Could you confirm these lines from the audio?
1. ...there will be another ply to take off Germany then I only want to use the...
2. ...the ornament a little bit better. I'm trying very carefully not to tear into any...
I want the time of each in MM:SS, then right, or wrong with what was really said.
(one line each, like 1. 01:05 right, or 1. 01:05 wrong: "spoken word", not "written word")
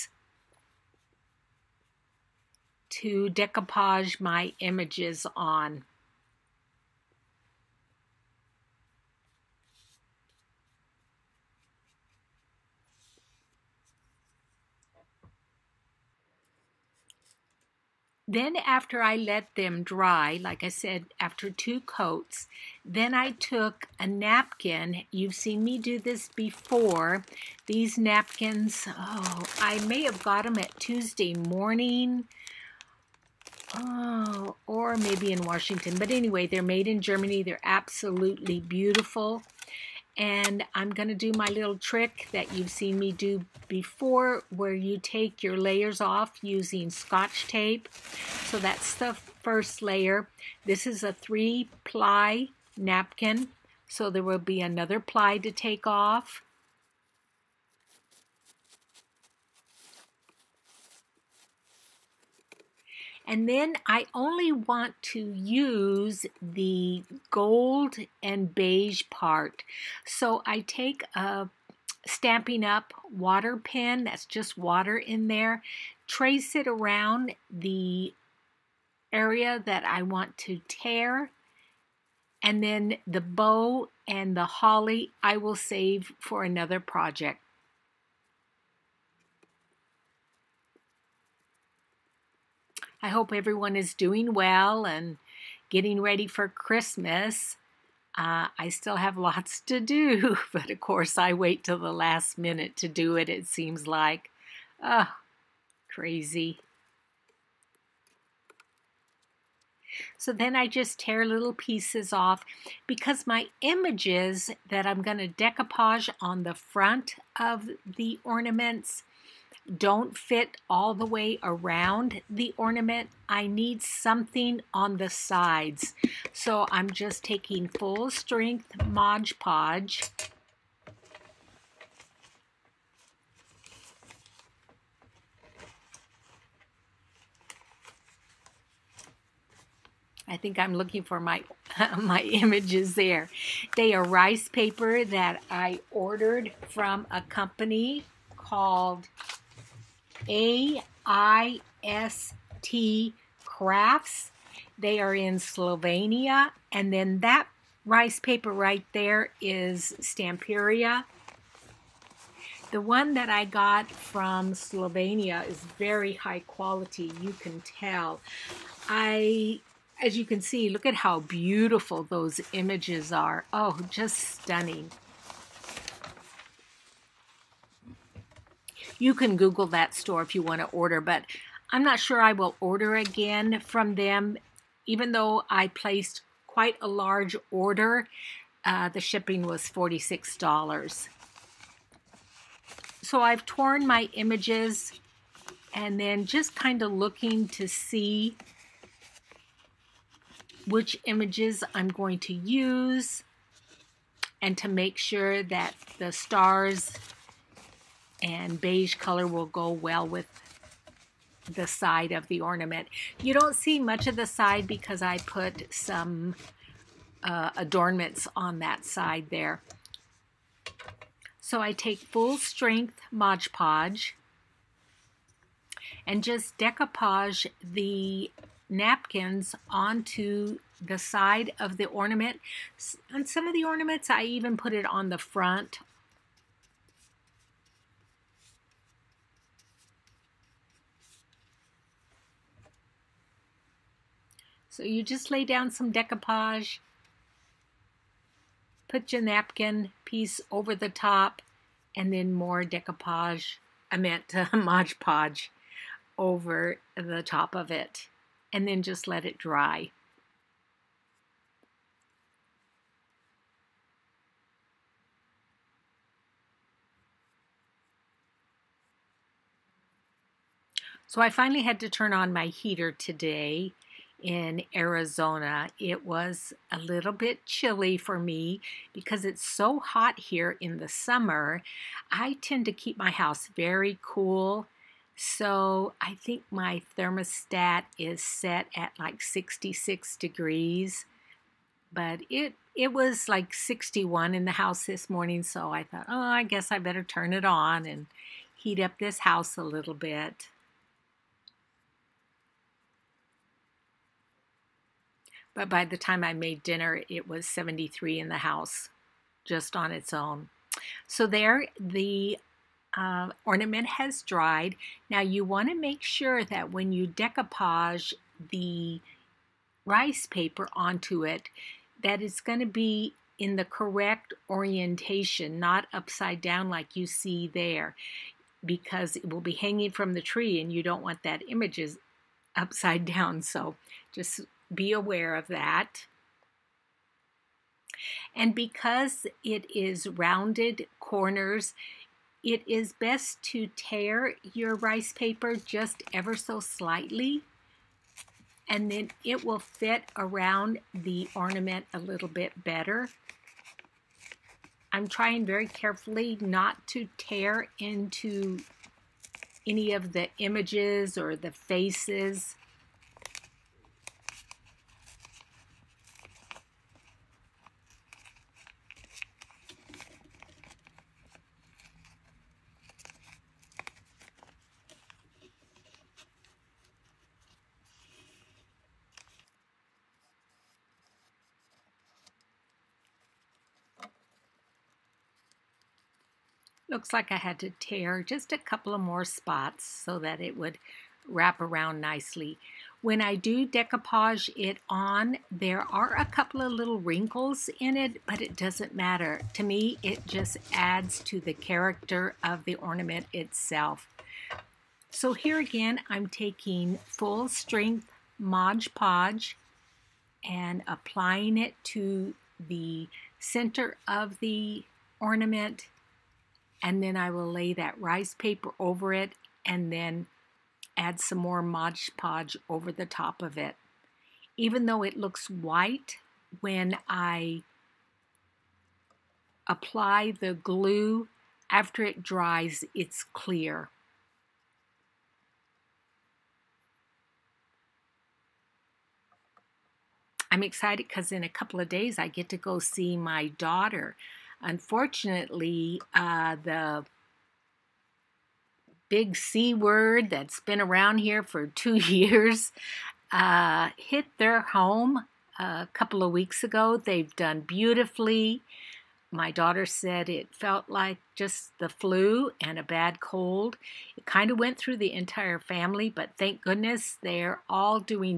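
1. 00:54 wrong: "And", not "Germany"
2. 05:50 right.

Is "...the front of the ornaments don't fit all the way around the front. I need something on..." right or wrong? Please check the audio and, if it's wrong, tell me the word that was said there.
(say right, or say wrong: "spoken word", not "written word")
wrong: "ornament", not "front".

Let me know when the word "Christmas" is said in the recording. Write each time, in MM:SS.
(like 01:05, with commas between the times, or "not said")
01:36.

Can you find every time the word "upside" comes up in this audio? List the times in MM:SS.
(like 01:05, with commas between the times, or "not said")
05:25, 05:32.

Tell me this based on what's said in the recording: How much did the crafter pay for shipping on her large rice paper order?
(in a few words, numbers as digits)
$46.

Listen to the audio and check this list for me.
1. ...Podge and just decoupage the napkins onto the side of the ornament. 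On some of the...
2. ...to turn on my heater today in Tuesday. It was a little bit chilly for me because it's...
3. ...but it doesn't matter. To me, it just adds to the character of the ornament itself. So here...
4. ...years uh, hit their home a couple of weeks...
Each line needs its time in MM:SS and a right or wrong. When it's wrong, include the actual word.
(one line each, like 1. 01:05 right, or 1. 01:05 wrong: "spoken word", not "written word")
1. 03:43 right
2. 04:31 wrong: "Arizona", not "Tuesday"
3. 06:38 right
4. 07:31 right.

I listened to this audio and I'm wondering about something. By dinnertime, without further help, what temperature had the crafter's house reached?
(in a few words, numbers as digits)
73 degrees.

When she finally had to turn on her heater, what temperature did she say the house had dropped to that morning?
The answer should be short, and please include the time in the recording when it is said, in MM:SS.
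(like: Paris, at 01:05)
61 degrees, at 04:53.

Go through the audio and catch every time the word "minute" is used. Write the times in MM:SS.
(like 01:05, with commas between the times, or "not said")
01:42.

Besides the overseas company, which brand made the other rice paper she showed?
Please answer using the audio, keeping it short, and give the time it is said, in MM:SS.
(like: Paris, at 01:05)
Stamperia, at 02:39.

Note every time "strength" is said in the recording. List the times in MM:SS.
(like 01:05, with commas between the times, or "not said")
02:08, 03:42, 06:47.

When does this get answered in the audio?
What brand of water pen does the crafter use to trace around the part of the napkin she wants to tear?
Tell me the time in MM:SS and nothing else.
01:12.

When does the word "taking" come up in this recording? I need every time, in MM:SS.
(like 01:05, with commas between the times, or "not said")
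02:07, 06:46.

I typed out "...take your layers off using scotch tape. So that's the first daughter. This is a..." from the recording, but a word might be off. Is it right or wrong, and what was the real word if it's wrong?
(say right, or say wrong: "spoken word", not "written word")
wrong: "layer", not "daughter".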